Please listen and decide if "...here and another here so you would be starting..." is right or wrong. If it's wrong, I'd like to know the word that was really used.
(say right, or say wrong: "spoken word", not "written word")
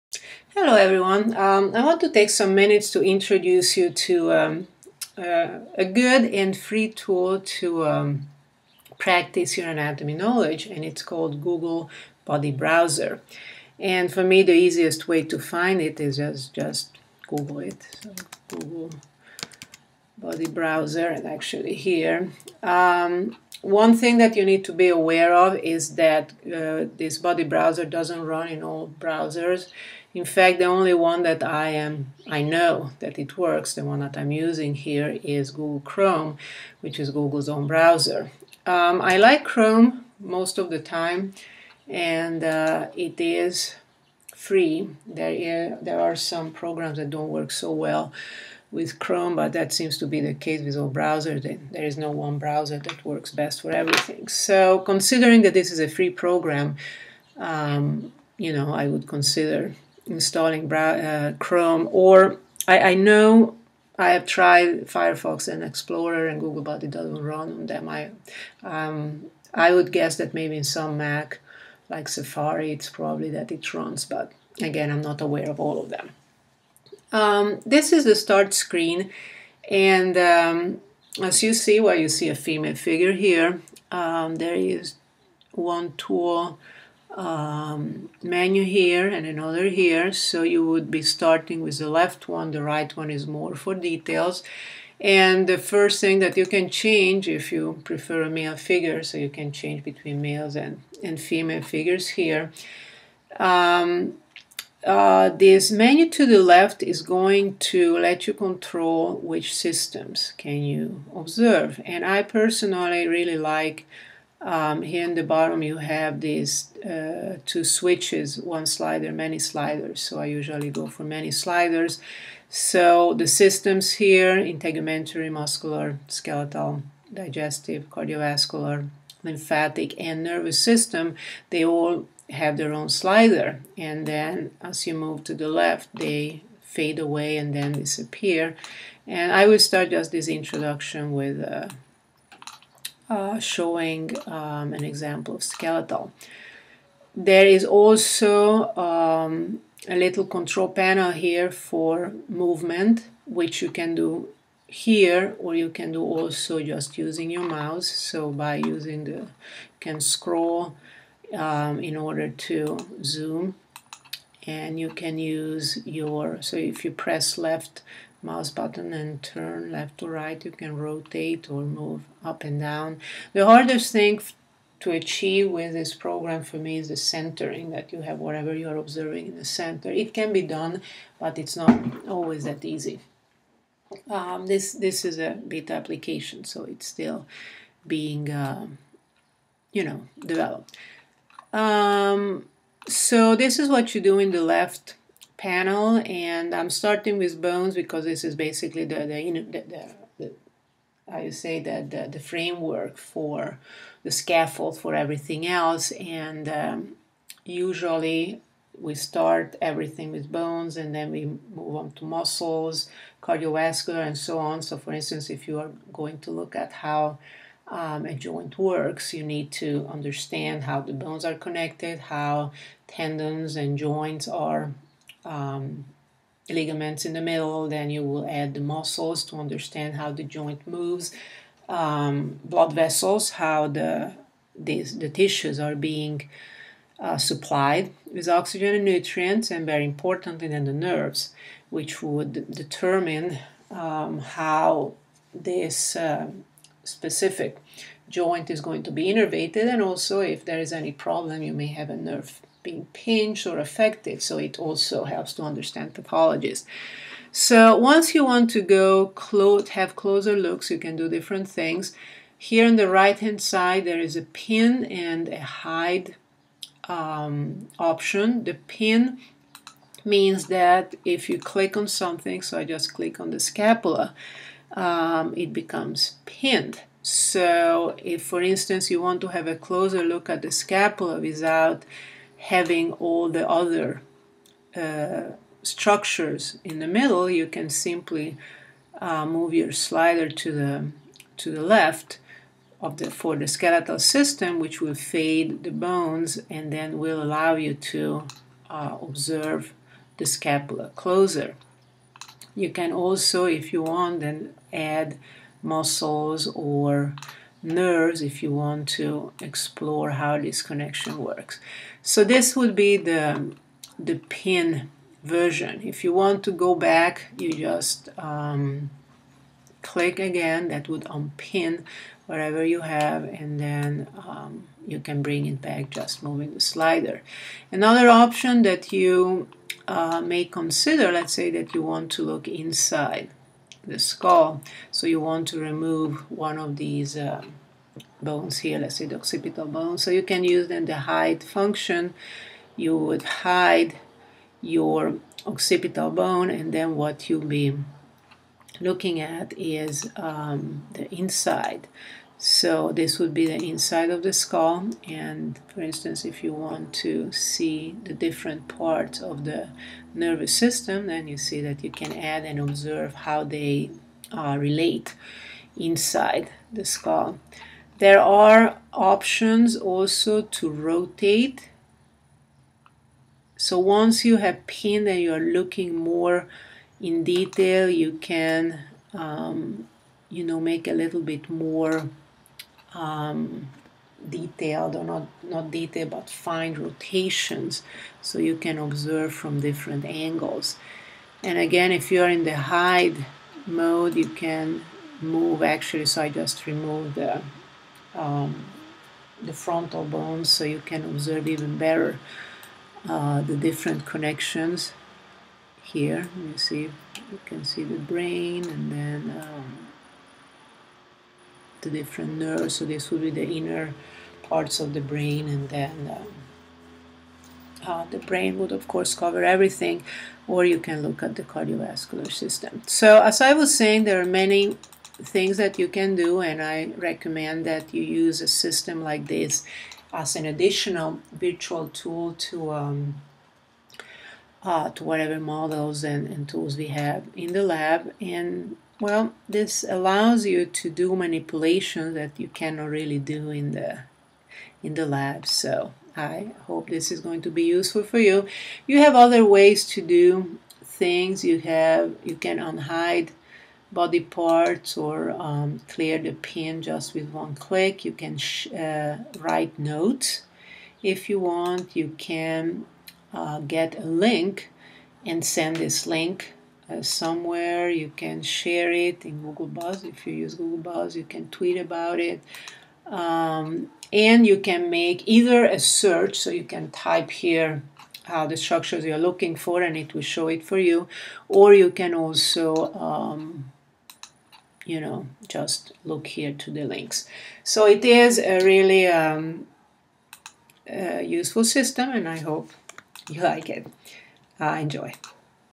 right.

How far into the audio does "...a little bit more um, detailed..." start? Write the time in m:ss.
6:20.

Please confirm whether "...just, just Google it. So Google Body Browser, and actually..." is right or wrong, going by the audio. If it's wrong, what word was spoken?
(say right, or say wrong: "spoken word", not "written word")
right.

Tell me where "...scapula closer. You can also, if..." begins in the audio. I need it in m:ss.
5:00.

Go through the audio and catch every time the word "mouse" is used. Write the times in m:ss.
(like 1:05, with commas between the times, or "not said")
2:37, 2:48.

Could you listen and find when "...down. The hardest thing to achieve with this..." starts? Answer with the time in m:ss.
2:52.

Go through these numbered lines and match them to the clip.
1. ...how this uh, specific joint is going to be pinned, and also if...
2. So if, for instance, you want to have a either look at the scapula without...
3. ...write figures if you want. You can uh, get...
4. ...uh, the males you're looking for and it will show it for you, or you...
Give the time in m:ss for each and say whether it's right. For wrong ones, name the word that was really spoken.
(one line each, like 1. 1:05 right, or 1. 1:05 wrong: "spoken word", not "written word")
1. 4:04 wrong: "innervated", not "pinned"
2. 4:37 wrong: "closer", not "either"
3. 7:39 wrong: "notes", not "figures"
4. 7:58 wrong: "structures", not "males".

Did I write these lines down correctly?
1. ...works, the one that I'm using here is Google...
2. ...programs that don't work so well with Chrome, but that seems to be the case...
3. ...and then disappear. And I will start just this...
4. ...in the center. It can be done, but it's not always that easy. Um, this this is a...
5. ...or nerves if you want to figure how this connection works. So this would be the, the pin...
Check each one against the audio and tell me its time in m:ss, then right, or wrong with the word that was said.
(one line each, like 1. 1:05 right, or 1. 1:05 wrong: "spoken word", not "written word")
1. 0:33 right
2. 0:46 right
3. 2:17 right
4. 2:59 right
5. 5:06 wrong: "explore", not "figure".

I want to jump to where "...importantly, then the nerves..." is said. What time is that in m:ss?
3:59.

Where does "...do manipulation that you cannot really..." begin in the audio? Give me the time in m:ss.
7:20.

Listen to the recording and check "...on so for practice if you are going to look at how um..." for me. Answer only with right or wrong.
wrong.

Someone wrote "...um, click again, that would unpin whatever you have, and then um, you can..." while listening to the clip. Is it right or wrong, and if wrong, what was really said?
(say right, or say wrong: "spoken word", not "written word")
right.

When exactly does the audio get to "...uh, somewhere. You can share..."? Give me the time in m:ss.
7:46.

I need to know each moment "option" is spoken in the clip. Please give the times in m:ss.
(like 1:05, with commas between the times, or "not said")
4:27, 5:28, 6:08.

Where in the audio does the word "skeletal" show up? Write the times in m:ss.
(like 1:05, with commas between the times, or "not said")
2:06, 2:25, 4:53.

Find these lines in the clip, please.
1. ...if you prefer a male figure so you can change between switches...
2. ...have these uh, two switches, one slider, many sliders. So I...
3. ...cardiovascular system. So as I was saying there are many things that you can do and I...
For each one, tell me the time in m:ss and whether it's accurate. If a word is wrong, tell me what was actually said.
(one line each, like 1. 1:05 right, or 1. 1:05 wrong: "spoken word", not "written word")
1. 1:37 wrong: "males", not "switches"
2. 1:55 right
3. 7:01 right.